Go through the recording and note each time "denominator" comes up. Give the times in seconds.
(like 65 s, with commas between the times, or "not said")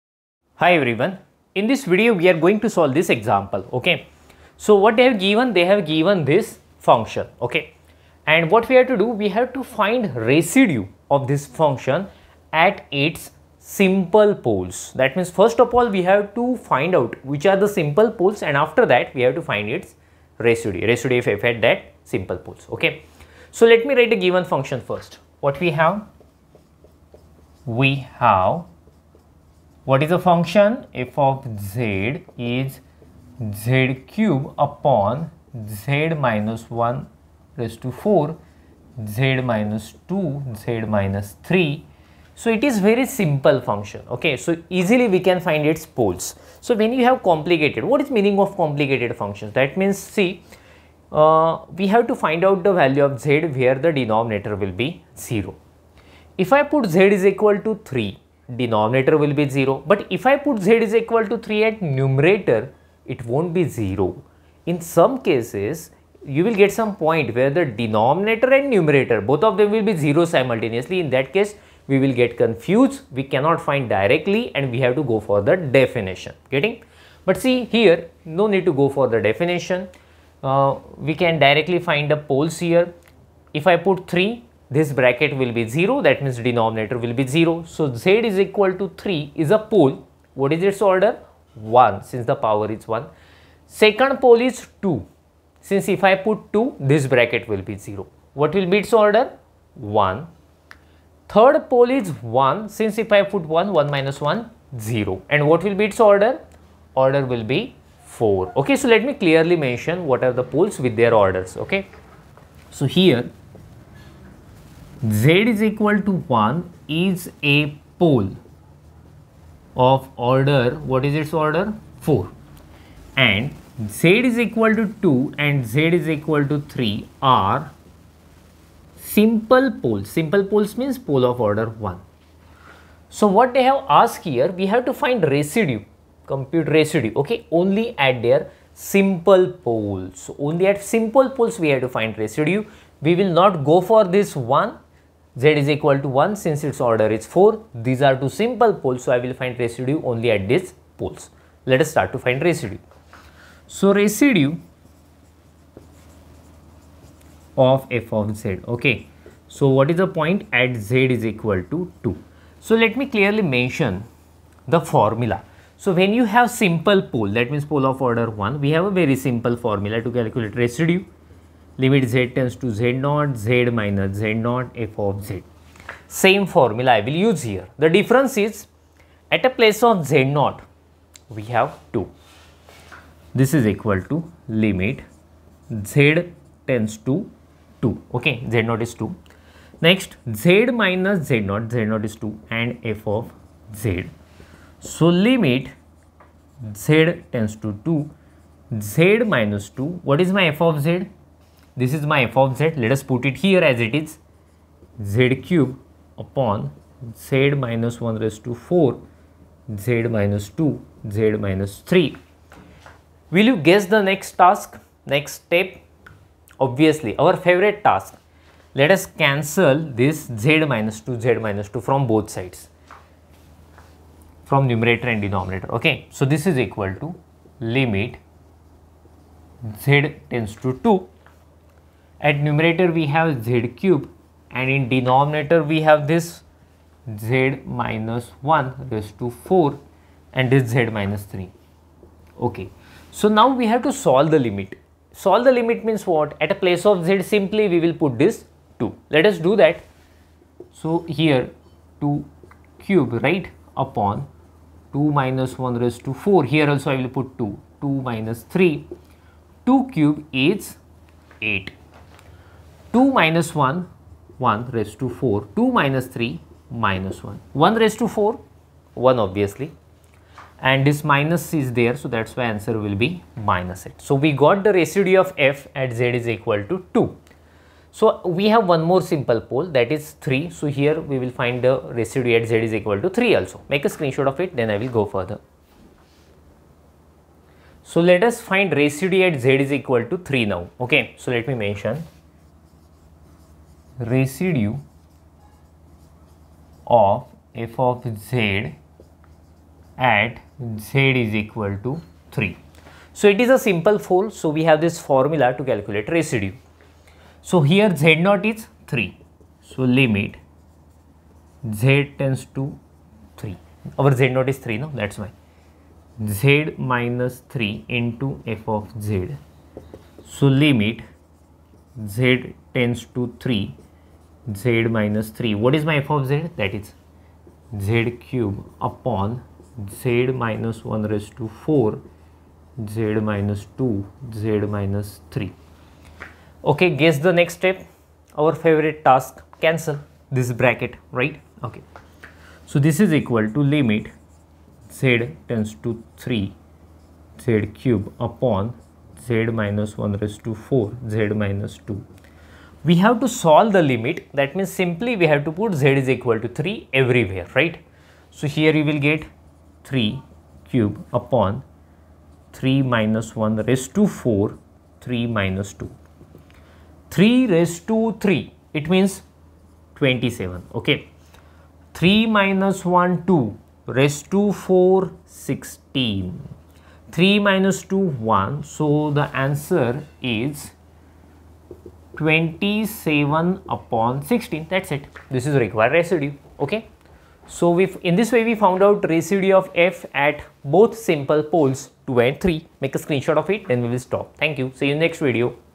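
53 s, 58 s, 67 s, 86 s, 225 s, 234 s.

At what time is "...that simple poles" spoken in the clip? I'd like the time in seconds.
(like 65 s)
21 s.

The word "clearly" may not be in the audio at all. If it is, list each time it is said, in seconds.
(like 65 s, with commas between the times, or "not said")
109 s, 163 s.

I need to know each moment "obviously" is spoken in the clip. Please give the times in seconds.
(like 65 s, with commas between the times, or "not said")
216 s, 269 s.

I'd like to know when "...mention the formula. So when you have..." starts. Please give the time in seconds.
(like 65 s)
163 s.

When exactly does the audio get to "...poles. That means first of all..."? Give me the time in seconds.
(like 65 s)
14 s.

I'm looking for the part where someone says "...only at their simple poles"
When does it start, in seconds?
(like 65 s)
137 s.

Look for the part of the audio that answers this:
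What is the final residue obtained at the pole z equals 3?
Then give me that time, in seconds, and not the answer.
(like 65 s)
382 s.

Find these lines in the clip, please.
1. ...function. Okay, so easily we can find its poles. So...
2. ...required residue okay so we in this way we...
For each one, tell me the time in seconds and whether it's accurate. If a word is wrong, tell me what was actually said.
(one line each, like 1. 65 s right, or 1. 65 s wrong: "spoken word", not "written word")
1. 43 s right
2. 385 s right.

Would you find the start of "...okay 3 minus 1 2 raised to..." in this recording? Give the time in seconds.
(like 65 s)
370 s.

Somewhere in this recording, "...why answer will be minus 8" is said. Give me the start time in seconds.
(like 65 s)
272 s.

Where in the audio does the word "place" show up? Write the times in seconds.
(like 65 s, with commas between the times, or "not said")
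179 s, 246 s.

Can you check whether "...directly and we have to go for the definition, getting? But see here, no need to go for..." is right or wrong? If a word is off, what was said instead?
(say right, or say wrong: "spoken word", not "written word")
right.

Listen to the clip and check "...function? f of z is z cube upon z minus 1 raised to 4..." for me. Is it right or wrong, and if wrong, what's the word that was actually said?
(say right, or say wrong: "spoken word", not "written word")
right.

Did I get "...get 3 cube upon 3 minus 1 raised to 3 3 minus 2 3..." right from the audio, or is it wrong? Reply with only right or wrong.
wrong.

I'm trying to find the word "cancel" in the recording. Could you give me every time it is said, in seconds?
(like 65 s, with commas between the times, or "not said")
219 s, 339 s.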